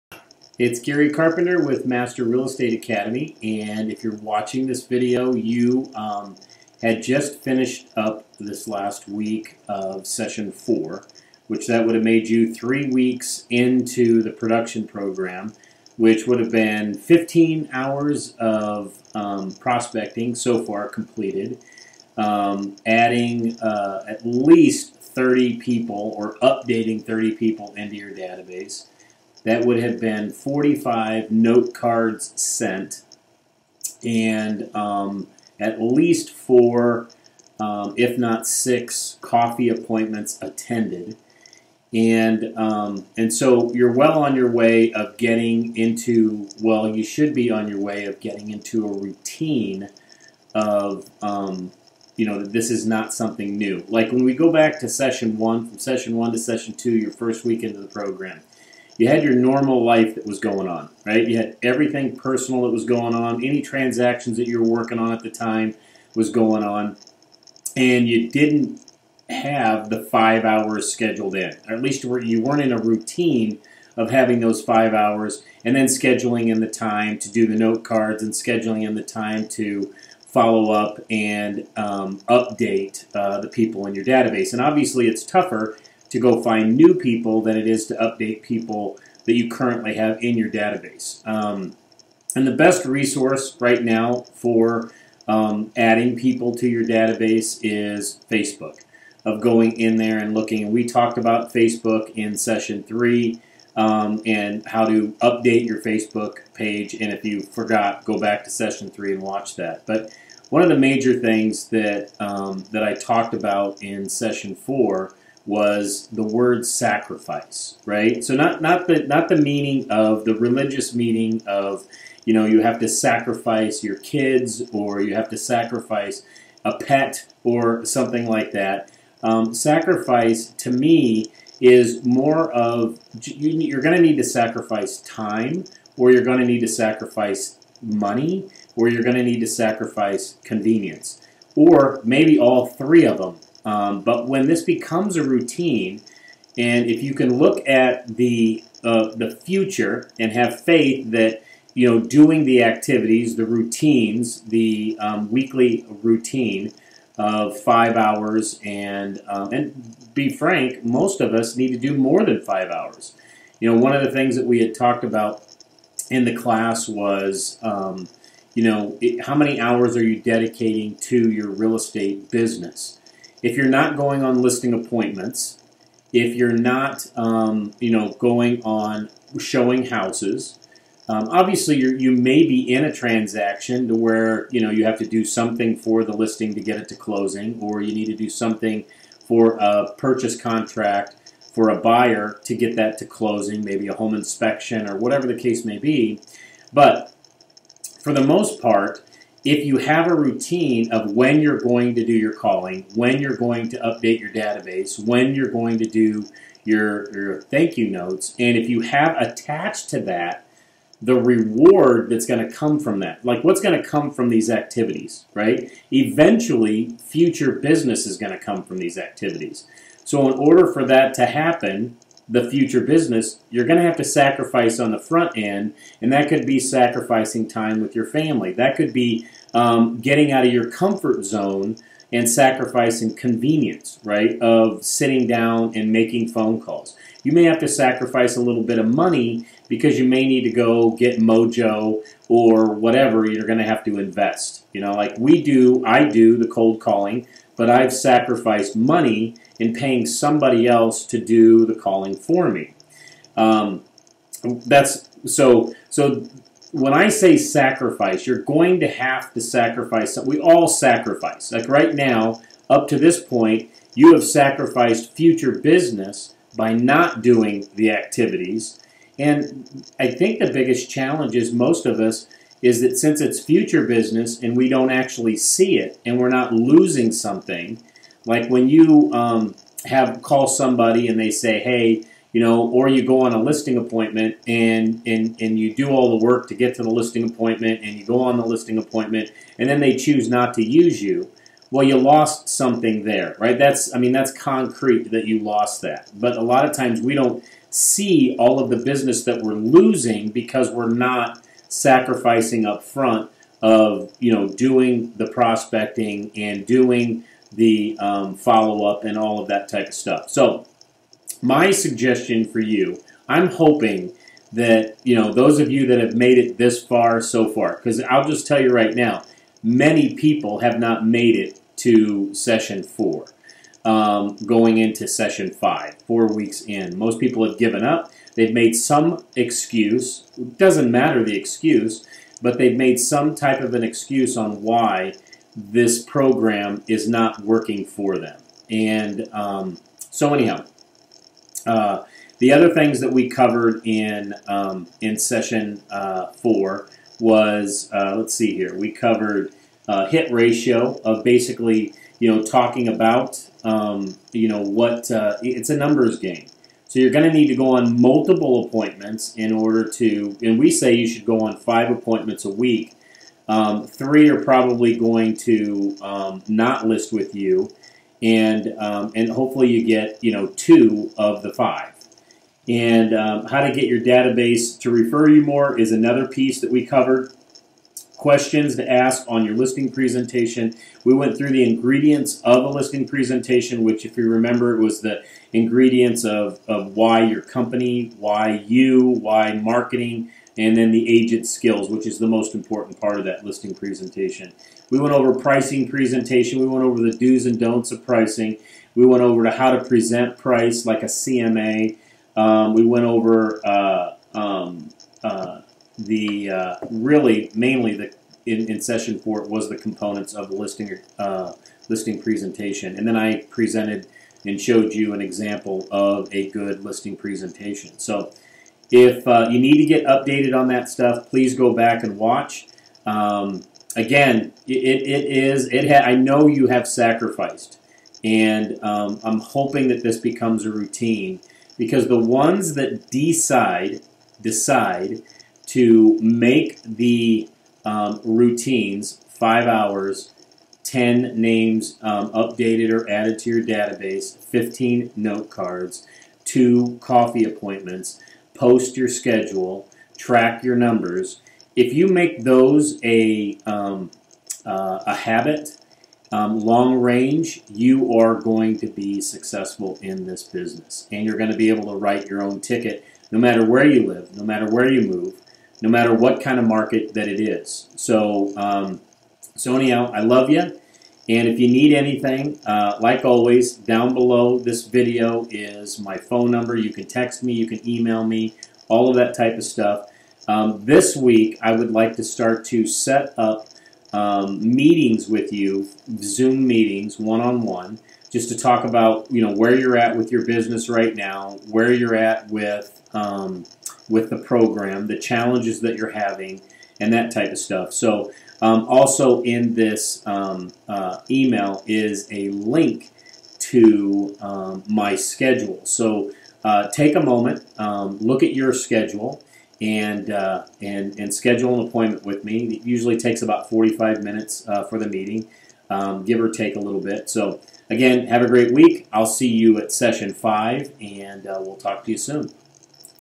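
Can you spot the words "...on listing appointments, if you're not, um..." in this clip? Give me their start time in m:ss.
2:54.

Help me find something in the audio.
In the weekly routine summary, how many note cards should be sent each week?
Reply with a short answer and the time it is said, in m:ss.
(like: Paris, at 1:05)
15, at 7:24.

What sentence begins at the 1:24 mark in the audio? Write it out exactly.
And obviously, it's tougher to go find new people than it is to update people that you currently have in your database.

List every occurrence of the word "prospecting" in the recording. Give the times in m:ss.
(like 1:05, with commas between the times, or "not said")
0:19, 5:05.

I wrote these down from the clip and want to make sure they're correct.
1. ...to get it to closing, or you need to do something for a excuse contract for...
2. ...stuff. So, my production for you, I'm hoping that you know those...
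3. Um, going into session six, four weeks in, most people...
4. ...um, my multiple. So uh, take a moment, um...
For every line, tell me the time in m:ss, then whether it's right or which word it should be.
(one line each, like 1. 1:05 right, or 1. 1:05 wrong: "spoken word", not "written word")
1. 3:06 wrong: "purchase", not "excuse"
2. 5:09 wrong: "suggestion", not "production"
3. 5:23 wrong: "five", not "six"
4. 8:24 wrong: "schedule", not "multiple".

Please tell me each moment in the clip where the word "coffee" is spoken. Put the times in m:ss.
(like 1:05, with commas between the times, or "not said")
0:39, 7:27.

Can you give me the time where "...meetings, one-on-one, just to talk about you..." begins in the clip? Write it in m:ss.
8:06.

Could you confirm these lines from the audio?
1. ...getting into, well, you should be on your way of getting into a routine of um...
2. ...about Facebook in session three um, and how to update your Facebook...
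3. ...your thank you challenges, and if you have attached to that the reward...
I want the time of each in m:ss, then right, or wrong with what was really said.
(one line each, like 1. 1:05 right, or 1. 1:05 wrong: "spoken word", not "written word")
1. 0:45 right
2. 1:41 right
3. 3:27 wrong: "notes", not "challenges".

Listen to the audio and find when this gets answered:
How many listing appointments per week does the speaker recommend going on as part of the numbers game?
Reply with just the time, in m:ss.
6:01.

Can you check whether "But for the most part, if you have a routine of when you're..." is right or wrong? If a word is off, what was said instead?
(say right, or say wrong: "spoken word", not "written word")
right.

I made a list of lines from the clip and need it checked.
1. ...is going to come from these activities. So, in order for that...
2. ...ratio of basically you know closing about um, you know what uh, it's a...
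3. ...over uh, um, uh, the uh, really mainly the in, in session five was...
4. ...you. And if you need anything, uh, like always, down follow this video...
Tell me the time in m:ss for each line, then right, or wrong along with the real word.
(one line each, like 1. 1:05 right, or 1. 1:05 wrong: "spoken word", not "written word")
1. 3:38 right
2. 5:50 wrong: "talking", not "closing"
3. 6:43 wrong: "four", not "five"
4. 7:50 wrong: "below", not "follow".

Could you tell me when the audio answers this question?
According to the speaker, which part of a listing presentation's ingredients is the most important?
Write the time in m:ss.
6:31.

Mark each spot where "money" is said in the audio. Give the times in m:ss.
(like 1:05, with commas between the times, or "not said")
2:17, 3:58, 4:08.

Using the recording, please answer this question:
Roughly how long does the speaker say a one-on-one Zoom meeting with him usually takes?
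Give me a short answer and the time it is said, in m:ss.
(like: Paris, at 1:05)
45 minutes, at 8:33.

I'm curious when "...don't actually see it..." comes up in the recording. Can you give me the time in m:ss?
4:34.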